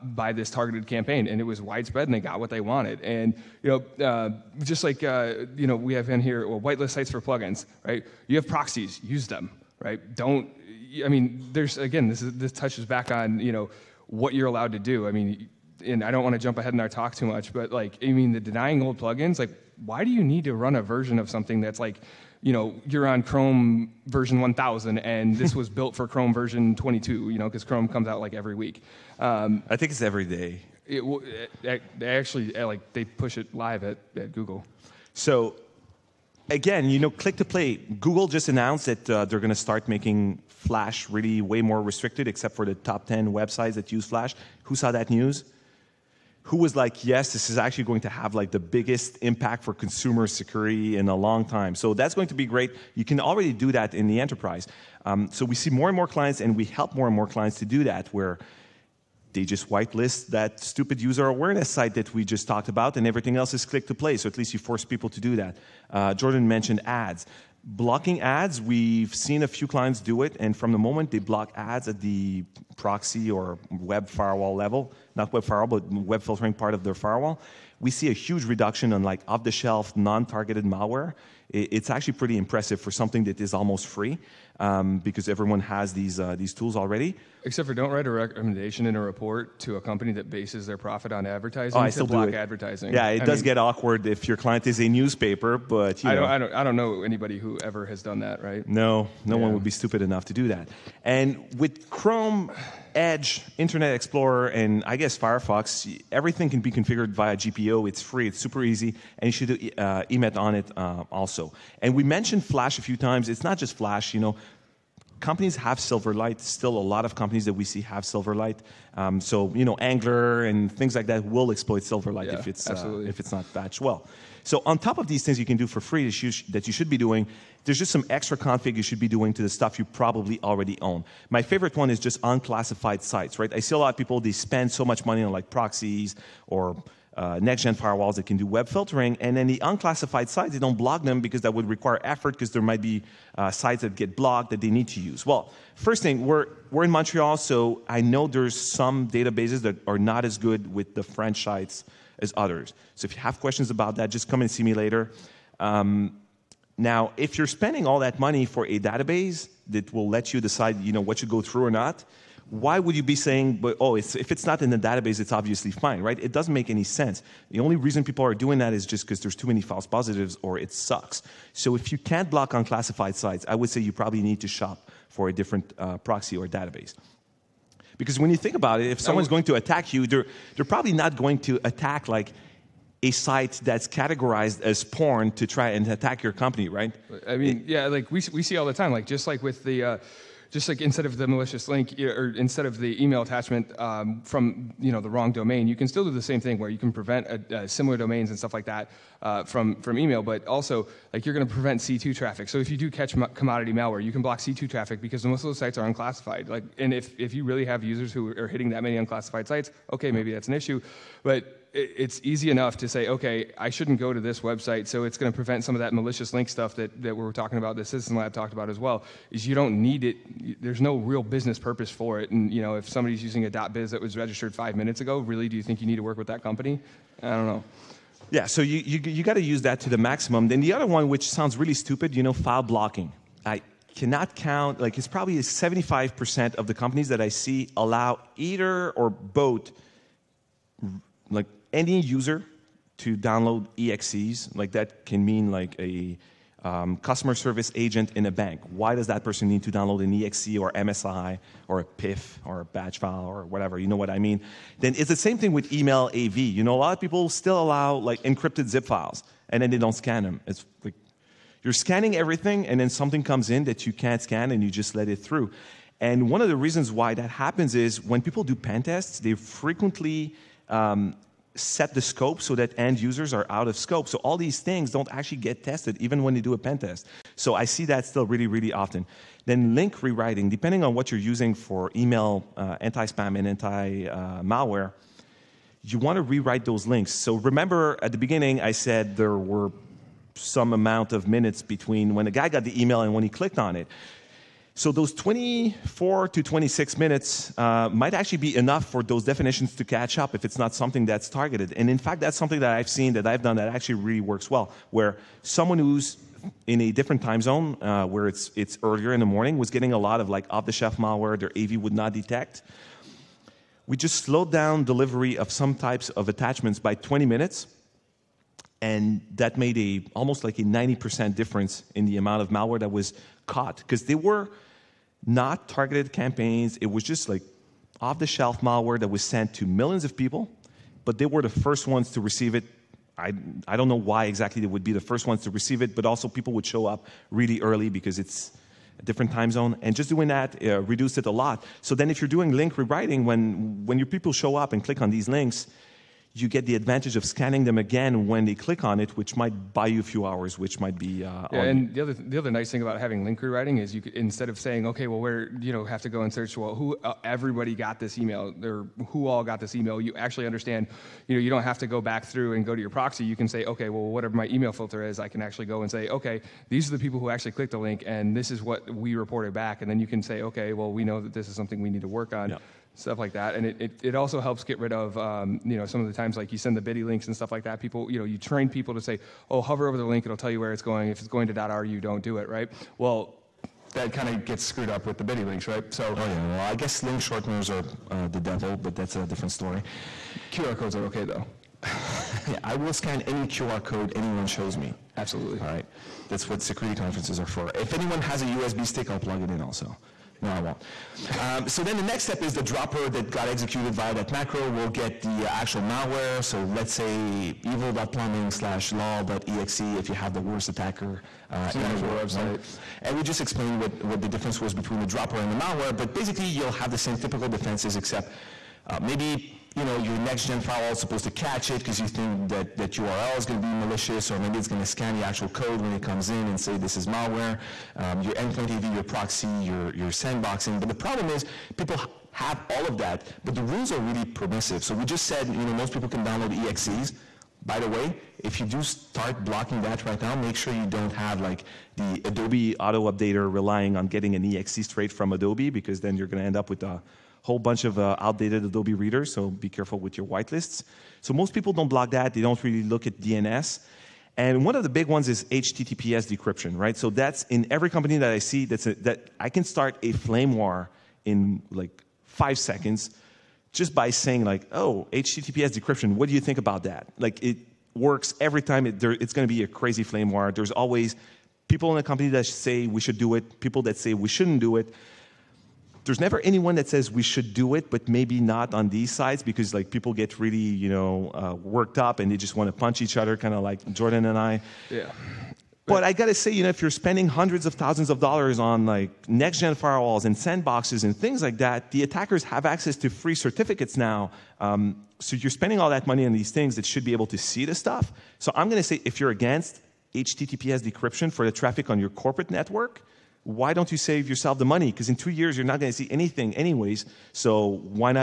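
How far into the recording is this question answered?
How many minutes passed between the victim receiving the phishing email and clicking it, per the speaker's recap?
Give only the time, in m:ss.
4:55.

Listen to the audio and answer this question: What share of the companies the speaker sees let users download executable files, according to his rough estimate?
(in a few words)
75%.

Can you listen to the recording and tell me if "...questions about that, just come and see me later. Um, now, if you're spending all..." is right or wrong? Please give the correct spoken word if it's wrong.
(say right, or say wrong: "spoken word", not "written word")
right.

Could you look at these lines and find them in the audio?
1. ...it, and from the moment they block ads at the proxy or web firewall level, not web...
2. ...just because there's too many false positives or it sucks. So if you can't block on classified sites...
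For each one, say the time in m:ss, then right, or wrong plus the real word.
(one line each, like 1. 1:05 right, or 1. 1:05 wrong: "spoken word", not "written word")
1. 1:10 right
2. 2:48 right.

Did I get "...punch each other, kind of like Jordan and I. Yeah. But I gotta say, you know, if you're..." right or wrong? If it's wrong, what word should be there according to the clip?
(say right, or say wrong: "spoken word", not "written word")
right.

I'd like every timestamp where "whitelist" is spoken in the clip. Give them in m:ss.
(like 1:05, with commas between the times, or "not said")
0:06, 0:59, 7:30.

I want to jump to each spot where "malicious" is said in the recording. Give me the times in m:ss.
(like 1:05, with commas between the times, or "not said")
3:11, 3:35, 7:03.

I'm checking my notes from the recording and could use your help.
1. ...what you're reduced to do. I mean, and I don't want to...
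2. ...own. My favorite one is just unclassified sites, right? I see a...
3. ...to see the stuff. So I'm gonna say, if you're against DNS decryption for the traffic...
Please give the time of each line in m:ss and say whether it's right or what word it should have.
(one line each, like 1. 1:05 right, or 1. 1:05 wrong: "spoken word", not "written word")
1. 0:14 wrong: "allowed", not "reduced"
2. 2:10 right
3. 8:17 wrong: "HTTPS", not "DNS".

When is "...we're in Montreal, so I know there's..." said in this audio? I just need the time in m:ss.
2:26.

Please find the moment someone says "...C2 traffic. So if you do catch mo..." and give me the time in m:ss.
3:21.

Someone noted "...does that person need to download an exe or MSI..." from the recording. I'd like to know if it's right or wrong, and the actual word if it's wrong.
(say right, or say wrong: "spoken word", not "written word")
right.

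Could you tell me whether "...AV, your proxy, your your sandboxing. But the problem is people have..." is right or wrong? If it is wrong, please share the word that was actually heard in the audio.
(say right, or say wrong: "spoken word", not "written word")
right.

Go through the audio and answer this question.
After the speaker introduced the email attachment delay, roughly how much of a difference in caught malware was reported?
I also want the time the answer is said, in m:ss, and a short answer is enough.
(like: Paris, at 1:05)
90%, at 5:20.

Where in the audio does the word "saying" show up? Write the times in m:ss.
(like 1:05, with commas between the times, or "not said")
2:43, 5:54, 7:44.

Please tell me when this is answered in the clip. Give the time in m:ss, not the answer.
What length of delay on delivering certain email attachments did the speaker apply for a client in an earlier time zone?
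5:16.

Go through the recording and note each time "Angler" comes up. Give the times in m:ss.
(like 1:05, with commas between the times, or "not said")
1:59.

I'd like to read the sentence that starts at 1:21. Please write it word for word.
It's actually pretty impressive for something that is almost free um, because everyone has these uh, these tools already.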